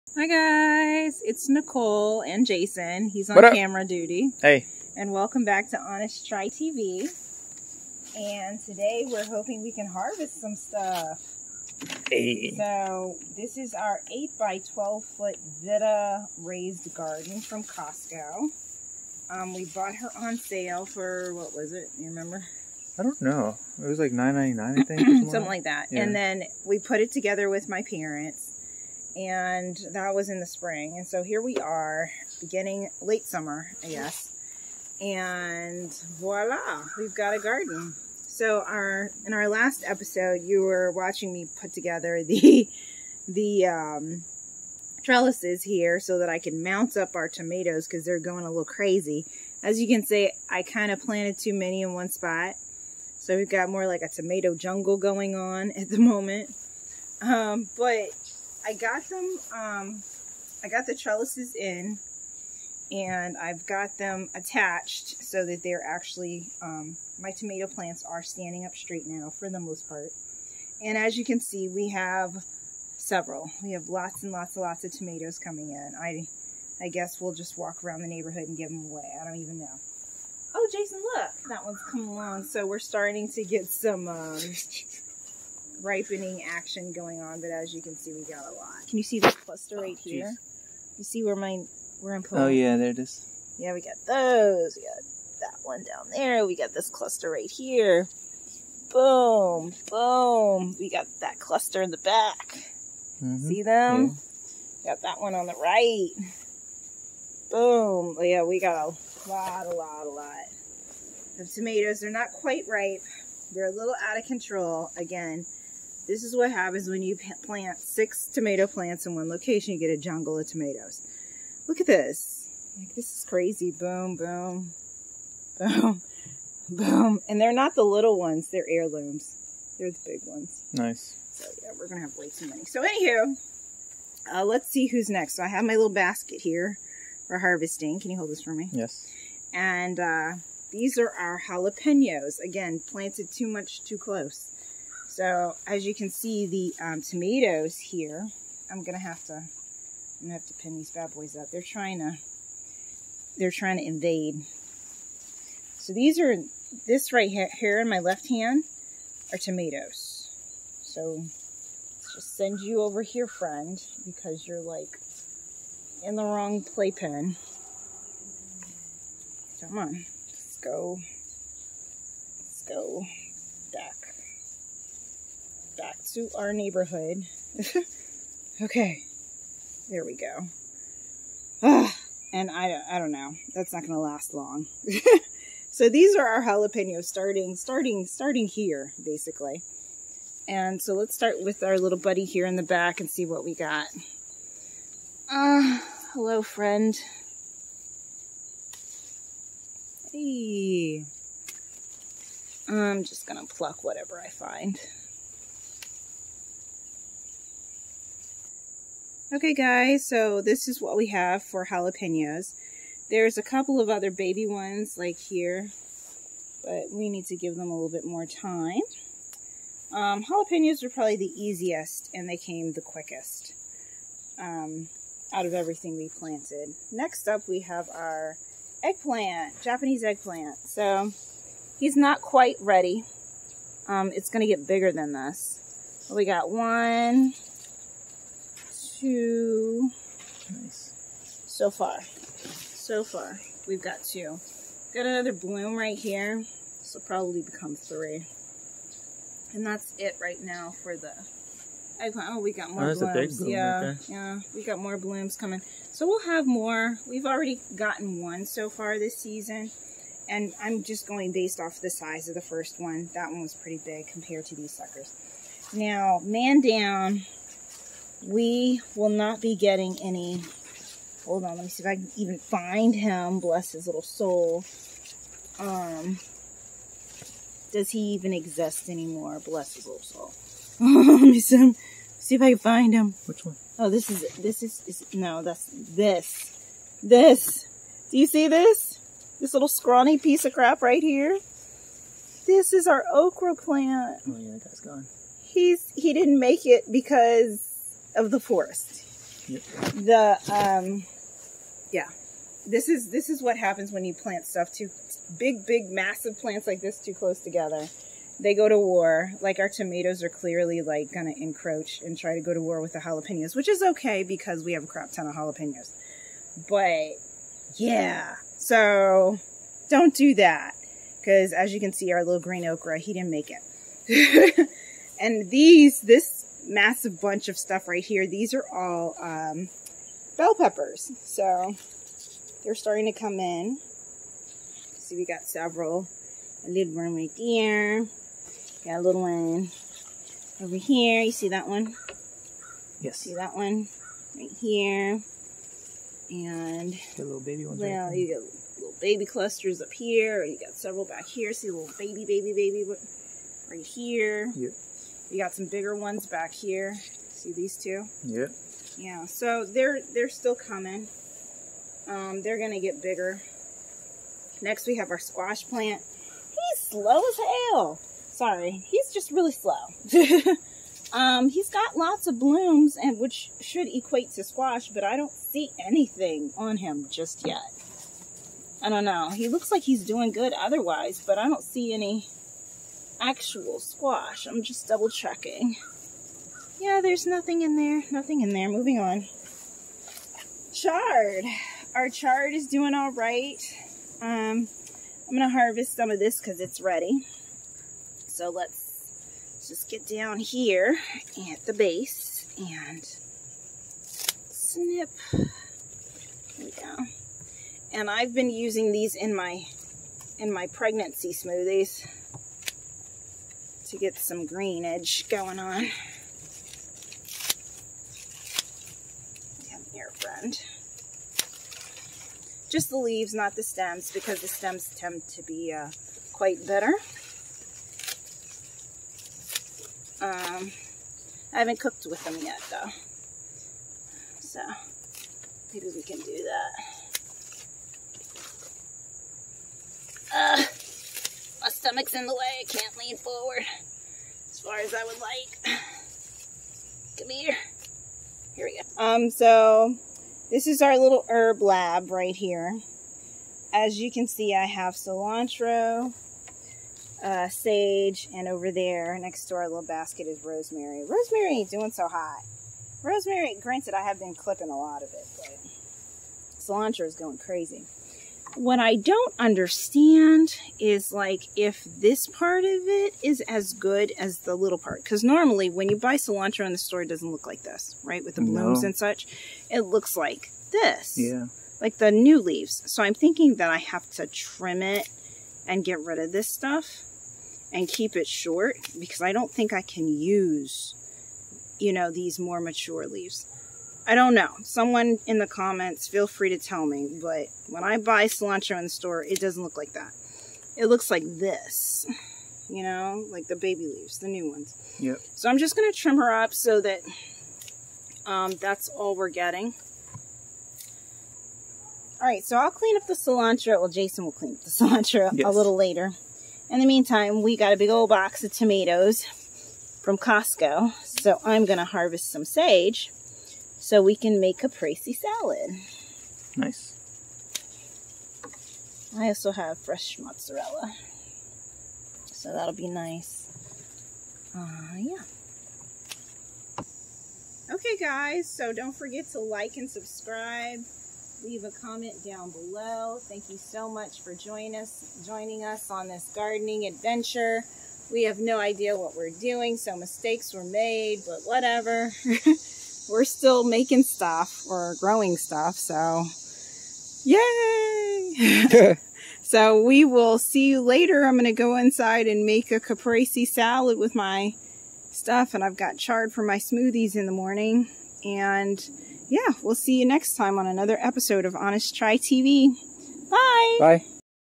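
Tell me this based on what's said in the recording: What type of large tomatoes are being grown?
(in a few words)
Heirlooms.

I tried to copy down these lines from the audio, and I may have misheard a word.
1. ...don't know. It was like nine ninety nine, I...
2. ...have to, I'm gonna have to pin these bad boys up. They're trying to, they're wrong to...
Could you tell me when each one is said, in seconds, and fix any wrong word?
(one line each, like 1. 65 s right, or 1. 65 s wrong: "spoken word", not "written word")
1. 23 s right
2. 148 s wrong: "trying", not "wrong".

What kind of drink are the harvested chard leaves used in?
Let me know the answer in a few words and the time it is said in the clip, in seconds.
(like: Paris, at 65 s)
Pregnancy smoothies, at 410 s.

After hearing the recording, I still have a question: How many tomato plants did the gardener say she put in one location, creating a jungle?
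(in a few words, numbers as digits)
6.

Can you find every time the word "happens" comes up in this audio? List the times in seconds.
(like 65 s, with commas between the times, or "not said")
116 s, 303 s.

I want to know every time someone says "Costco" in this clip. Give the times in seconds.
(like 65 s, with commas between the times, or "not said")
17 s, 520 s.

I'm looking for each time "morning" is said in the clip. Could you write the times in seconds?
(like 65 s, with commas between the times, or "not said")
567 s.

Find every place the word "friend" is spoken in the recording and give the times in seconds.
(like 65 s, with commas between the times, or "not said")
163 s, 196 s, 420 s.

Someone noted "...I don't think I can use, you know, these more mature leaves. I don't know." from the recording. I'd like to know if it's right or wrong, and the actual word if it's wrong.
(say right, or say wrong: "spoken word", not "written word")
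right.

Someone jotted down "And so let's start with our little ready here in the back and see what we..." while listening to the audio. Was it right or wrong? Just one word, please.
wrong.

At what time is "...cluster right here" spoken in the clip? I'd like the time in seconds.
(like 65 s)
96 s.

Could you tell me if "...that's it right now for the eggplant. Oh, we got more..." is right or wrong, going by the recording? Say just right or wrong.
right.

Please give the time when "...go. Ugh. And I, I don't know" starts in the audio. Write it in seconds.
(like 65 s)
180 s.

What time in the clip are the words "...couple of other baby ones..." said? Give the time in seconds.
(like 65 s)
213 s.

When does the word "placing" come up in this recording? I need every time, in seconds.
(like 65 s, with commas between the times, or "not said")
not said.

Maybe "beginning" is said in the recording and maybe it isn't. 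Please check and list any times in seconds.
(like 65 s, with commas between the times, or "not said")
32 s.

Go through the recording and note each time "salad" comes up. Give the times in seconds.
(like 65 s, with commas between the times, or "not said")
525 s, 563 s.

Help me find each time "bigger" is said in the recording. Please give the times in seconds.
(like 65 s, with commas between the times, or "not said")
234 s, 355 s, 363 s.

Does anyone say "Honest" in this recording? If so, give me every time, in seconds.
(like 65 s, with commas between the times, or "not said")
5 s, 571 s.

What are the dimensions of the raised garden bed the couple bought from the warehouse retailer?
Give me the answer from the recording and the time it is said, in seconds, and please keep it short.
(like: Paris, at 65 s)
8 by 12 foot, at 14 s.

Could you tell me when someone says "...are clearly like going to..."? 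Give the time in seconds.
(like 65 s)
310 s.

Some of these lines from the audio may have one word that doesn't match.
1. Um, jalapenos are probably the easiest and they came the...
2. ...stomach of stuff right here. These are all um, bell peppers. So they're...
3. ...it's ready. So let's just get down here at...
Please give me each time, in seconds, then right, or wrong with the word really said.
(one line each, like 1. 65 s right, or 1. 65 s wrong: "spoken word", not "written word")
1. 219 s right
2. 327 s wrong: "bunch", not "stomach"
3. 396 s right.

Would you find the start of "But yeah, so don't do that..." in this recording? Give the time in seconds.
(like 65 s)
316 s.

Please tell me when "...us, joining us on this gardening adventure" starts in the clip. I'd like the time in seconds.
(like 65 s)
544 s.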